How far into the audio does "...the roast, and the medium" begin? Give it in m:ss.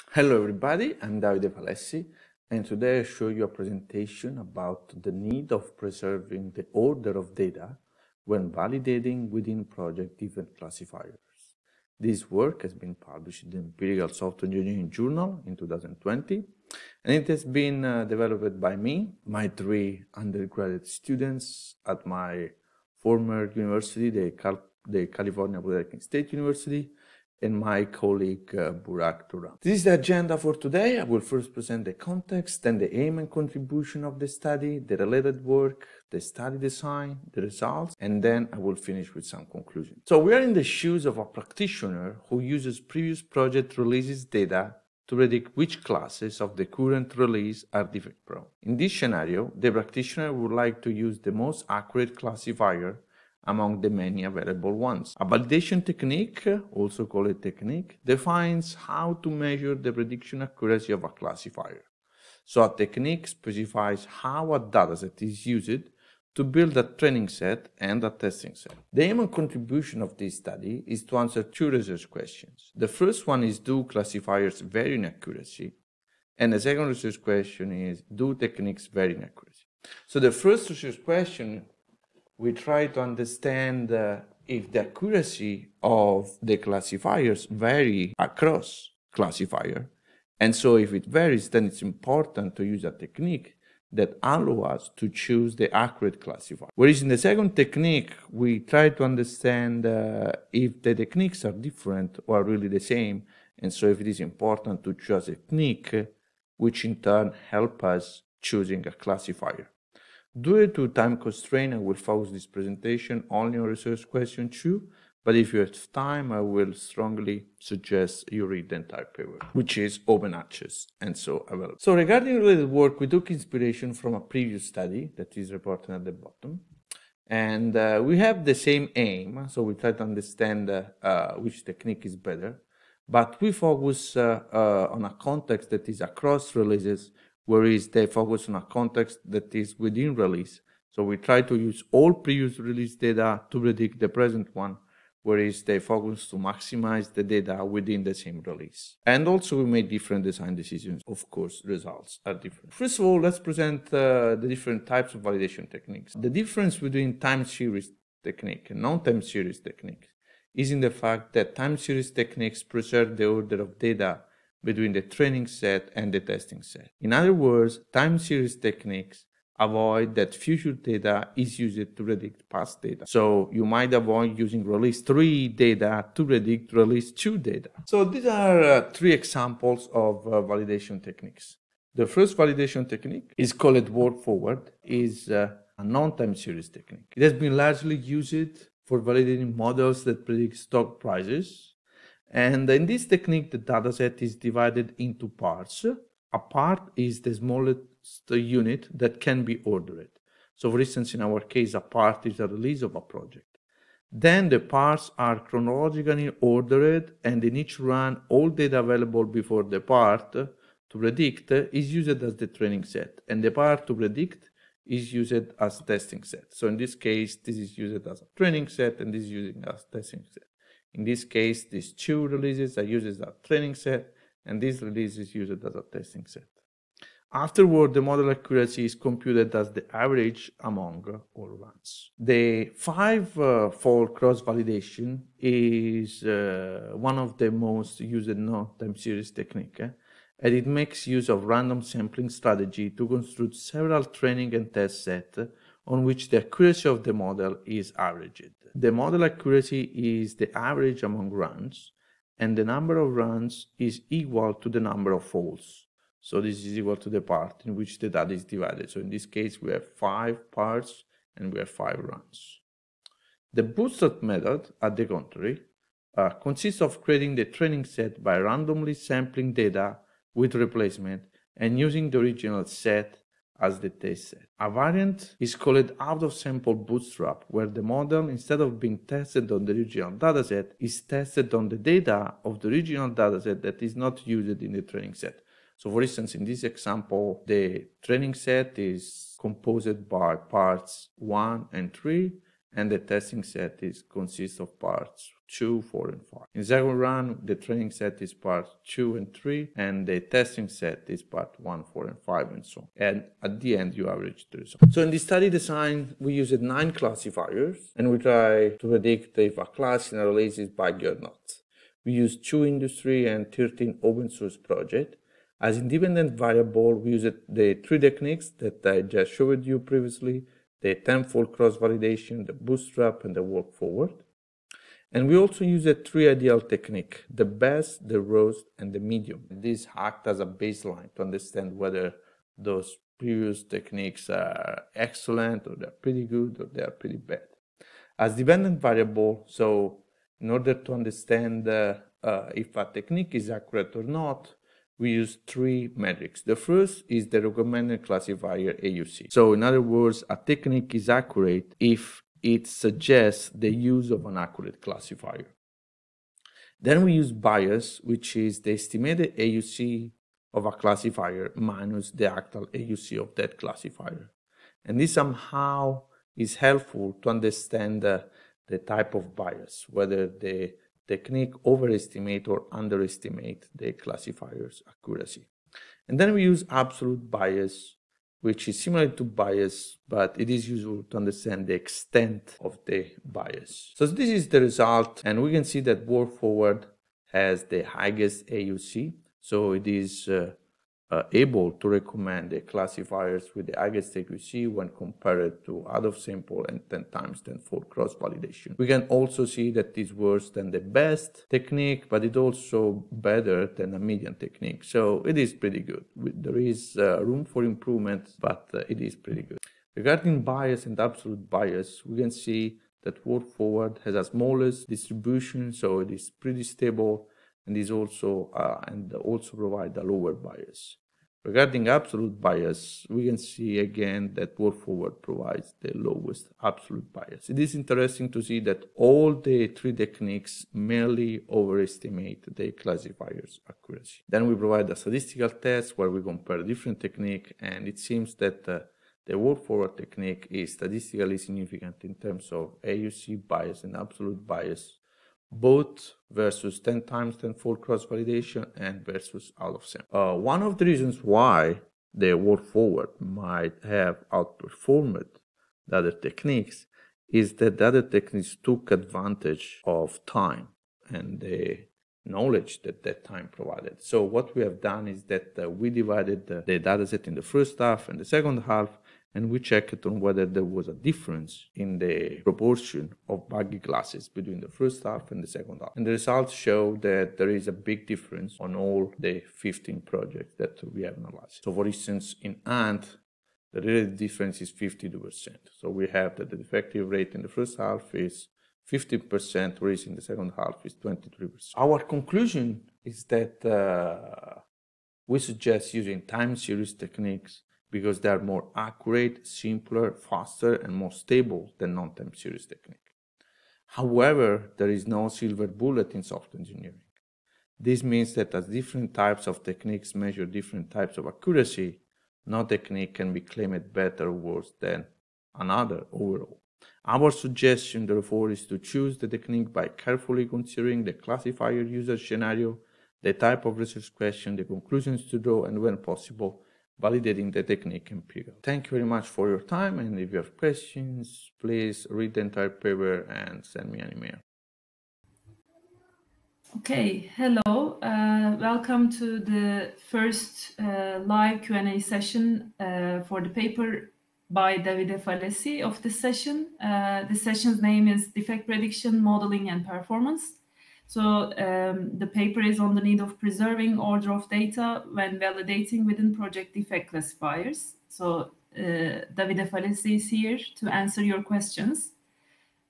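5:28.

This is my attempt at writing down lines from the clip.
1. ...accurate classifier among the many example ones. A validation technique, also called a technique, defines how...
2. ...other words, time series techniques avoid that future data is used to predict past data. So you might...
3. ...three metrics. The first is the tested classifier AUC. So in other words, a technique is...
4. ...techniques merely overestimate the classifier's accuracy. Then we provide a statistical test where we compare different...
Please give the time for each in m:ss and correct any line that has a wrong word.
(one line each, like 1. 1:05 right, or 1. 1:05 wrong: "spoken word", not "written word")
1. 0:51 wrong: "available", not "example"
2. 2:47 right
3. 5:45 wrong: "recommended", not "tested"
4. 7:09 right.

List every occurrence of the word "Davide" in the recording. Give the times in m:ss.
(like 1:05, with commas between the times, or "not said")
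0:01, 9:04, 9:19.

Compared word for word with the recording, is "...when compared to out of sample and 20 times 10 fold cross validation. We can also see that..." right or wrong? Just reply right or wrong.
wrong.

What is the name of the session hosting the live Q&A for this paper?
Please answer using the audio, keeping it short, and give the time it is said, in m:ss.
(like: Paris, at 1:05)
Defect Prediction, Modeling and Performance, at 9:08.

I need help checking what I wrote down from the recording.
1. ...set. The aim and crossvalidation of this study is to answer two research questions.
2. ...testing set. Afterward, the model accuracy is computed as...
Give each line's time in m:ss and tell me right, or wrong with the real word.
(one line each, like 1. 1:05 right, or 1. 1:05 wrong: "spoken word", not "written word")
1. 1:08 wrong: "contribution", not "crossvalidation"
2. 3:45 right.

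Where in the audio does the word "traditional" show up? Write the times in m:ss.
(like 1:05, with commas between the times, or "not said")
not said.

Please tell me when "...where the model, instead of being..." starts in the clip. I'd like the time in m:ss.
4:37.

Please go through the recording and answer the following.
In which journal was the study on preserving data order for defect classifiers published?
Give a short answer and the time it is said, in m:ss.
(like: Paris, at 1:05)
Empirical Software Engineering Journal, at 0:13.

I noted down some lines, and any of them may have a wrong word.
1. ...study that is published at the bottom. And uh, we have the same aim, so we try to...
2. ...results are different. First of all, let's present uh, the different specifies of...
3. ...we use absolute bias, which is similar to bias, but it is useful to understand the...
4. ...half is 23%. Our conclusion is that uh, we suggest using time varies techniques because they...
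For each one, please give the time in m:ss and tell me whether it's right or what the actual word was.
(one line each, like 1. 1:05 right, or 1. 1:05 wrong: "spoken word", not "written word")
1. 2:04 wrong: "reported", not "published"
2. 2:31 wrong: "types", not "specifies"
3. 6:16 right
4. 8:10 wrong: "series", not "varies".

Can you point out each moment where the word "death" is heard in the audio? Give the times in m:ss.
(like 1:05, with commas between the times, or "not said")
not said.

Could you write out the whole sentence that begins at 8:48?
Thank you very much for your time and if you have questions, please read the entire paper and send me an email.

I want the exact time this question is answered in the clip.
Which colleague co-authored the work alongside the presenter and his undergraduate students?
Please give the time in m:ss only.
0:28.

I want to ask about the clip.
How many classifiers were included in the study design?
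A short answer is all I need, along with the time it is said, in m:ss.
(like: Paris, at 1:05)
9, at 5:06.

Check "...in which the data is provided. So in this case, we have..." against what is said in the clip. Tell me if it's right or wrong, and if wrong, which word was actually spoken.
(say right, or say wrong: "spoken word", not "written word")
wrong: "divided", not "provided".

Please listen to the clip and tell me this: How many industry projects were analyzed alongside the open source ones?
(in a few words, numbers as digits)
2.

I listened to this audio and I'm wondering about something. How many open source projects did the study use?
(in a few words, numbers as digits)
13.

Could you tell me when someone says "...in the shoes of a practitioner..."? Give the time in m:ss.
0:40.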